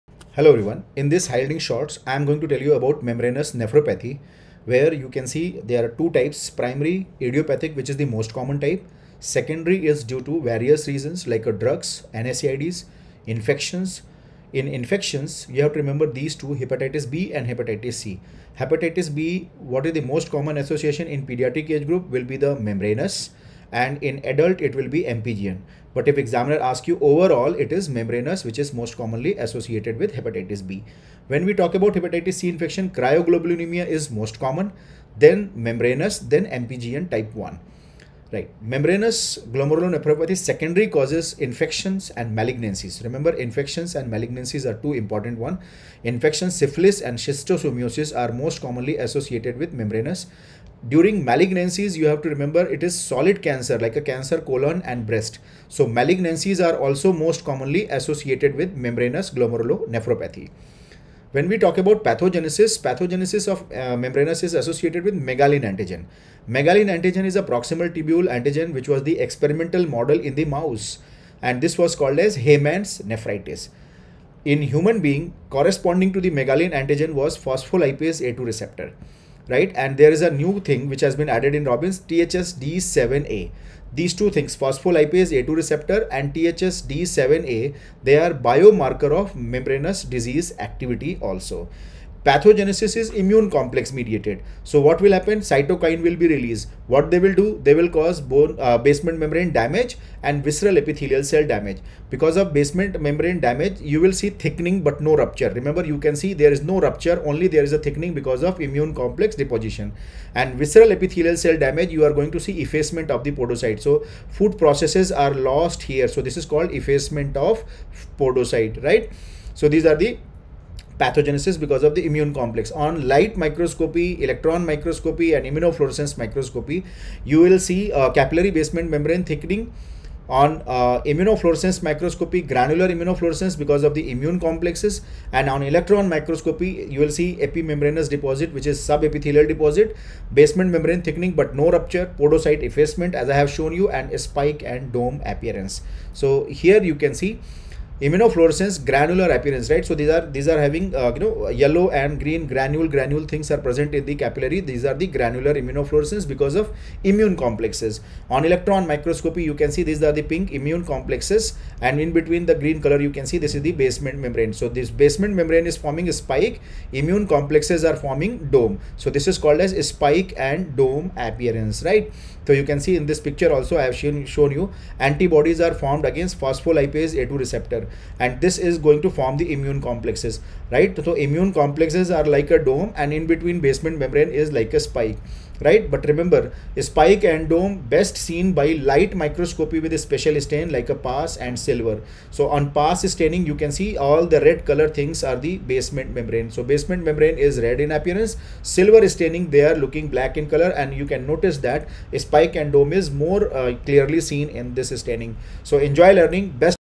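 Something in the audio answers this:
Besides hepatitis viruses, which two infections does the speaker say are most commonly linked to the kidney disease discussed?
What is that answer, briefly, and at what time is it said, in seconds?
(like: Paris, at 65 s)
Syphilis and schistosomiasis, at 46 s.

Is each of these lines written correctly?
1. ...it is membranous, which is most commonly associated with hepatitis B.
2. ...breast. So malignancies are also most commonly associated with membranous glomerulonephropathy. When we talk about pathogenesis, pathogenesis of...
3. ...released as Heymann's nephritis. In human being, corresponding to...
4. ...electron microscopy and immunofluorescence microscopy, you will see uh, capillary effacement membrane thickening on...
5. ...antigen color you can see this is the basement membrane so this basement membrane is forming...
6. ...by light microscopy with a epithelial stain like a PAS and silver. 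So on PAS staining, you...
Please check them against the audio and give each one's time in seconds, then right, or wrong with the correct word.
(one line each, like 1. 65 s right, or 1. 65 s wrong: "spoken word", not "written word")
1. 27 s right
2. 55 s right
3. 71 s wrong: "called", not "released"
4. 124 s wrong: "basement", not "effacement"
5. 162 s wrong: "green", not "antigen"
6. 188 s wrong: "special", not "epithelial".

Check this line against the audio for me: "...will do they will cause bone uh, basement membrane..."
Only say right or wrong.
right.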